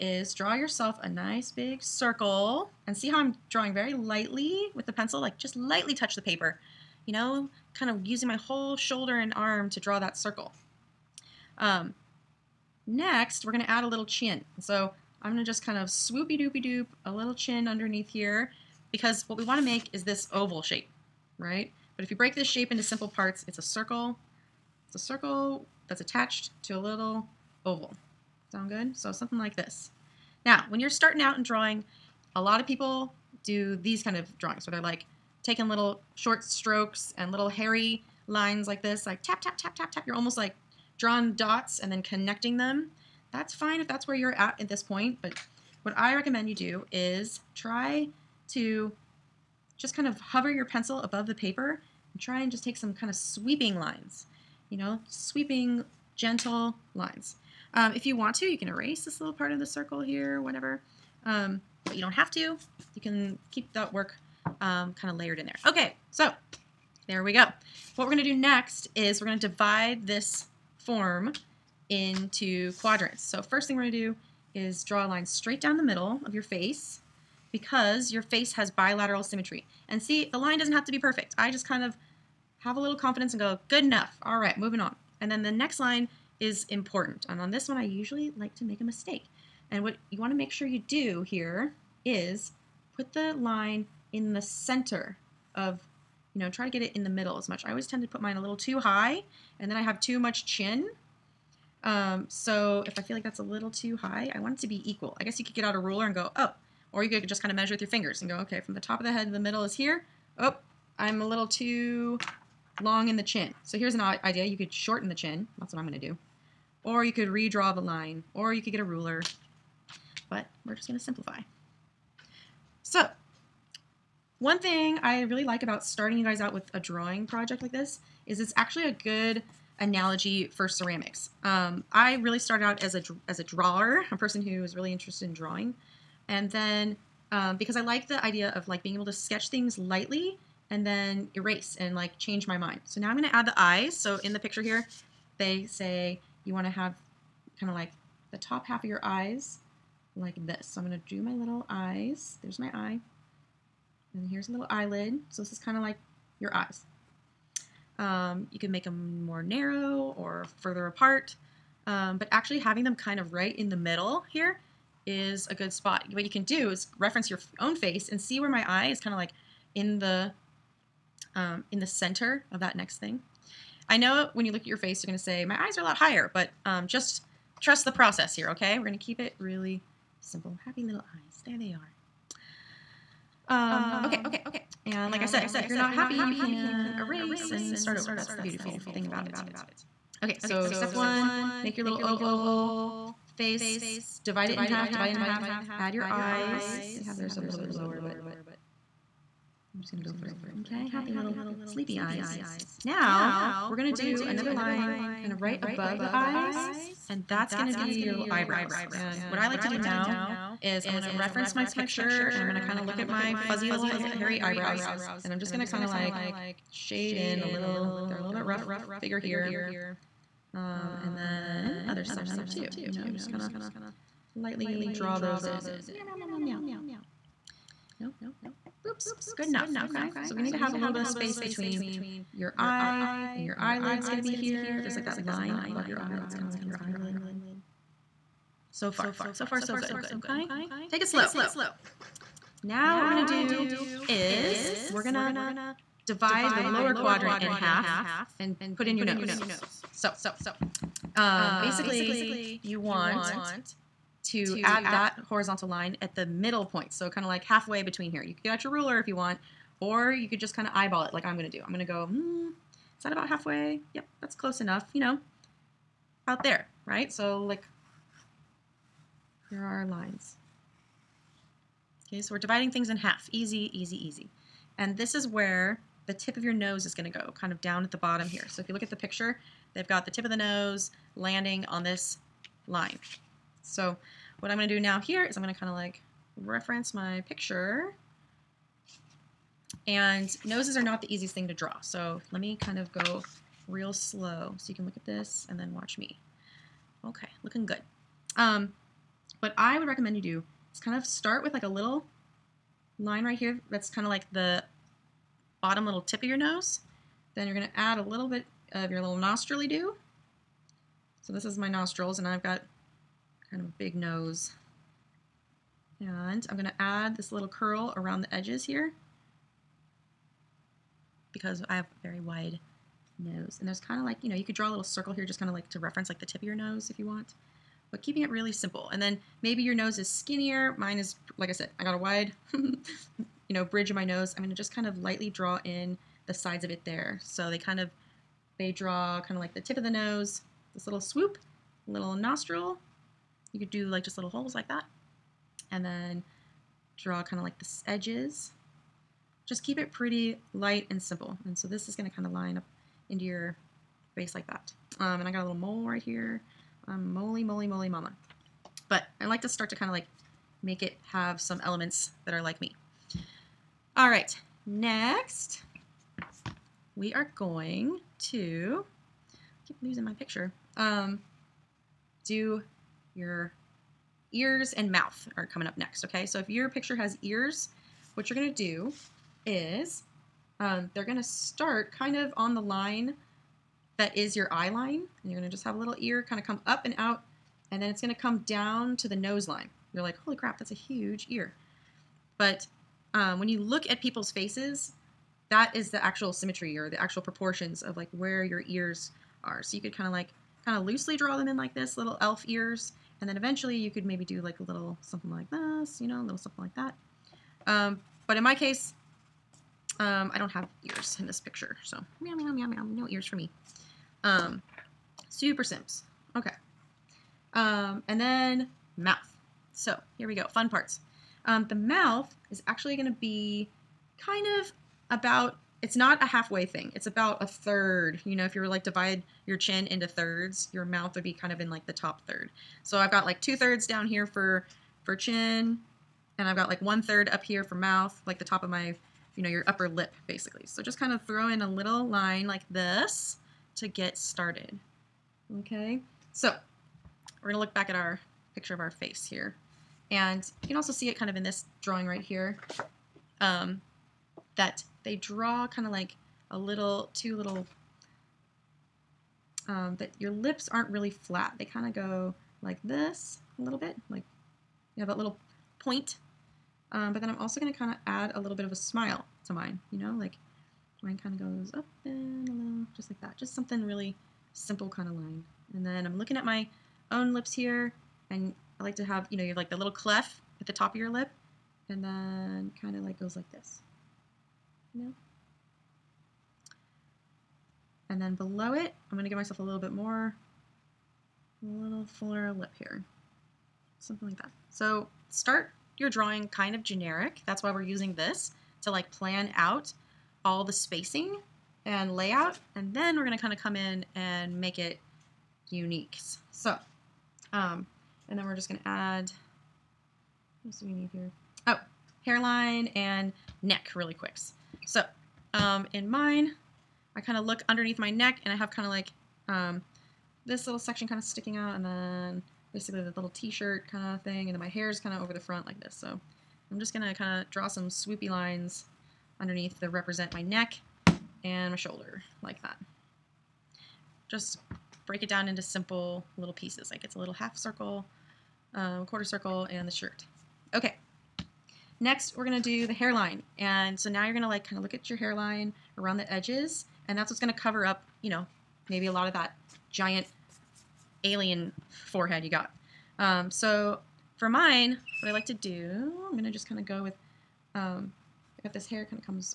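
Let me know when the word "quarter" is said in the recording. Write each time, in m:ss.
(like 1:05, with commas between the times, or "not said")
8:59.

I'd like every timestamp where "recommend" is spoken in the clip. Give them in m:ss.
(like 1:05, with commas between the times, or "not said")
0:46, 4:59.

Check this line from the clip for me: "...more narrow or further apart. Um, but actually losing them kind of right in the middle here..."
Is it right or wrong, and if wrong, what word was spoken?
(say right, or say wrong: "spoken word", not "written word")
wrong: "having", not "losing".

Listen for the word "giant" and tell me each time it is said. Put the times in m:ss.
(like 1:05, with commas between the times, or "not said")
9:09.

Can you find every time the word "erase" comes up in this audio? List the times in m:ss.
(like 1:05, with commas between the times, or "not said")
0:58, 2:21, 3:06.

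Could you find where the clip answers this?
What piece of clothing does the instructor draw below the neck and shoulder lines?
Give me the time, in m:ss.
8:43.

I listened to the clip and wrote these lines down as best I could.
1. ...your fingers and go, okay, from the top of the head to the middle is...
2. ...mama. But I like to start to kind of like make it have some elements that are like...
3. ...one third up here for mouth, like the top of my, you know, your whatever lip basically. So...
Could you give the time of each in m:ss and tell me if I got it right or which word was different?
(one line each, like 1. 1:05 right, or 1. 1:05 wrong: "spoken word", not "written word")
1. 1:47 right
2. 5:57 right
3. 7:16 wrong: "upper", not "whatever".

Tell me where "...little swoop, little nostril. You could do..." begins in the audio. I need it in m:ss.
5:40.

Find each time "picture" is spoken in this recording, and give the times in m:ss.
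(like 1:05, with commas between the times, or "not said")
2:24, 3:31, 4:38, 4:47, 6:10, 6:16, 6:51, 7:28.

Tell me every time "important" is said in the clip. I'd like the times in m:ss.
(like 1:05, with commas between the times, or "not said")
1:26.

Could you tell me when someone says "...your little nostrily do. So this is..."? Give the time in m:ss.
5:08.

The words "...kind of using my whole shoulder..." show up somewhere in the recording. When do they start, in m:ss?
0:07.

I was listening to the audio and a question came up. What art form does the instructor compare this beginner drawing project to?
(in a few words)
ceramics.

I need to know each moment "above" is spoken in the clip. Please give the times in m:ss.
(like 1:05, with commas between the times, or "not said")
0:50, 3:25, 3:55.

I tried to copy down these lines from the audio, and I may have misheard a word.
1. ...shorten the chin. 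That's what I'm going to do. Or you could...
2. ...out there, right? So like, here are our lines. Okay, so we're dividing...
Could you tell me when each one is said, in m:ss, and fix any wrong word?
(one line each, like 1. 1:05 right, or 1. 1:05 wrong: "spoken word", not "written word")
1. 1:54 right
2. 4:26 right.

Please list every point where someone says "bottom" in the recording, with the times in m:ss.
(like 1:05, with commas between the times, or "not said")
4:37, 5:05.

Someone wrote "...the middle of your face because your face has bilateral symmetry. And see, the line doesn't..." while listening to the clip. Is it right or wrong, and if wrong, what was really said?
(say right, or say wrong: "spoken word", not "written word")
right.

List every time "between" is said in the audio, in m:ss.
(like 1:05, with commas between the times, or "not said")
3:51, 4:17.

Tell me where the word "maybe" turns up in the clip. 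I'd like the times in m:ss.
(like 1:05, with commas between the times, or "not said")
5:29, 6:44, 9:08.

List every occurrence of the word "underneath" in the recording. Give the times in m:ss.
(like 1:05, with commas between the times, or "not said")
0:17, 8:37, 8:49.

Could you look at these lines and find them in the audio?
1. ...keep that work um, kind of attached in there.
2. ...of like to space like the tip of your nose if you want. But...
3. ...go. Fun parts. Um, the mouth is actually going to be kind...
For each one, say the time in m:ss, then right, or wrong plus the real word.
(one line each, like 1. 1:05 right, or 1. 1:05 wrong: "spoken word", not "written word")
1. 1:03 wrong: "layered", not "attached"
2. 5:25 wrong: "reference", not "space"
3. 7:00 right.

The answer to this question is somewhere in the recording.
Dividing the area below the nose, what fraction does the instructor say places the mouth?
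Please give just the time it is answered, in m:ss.
7:07.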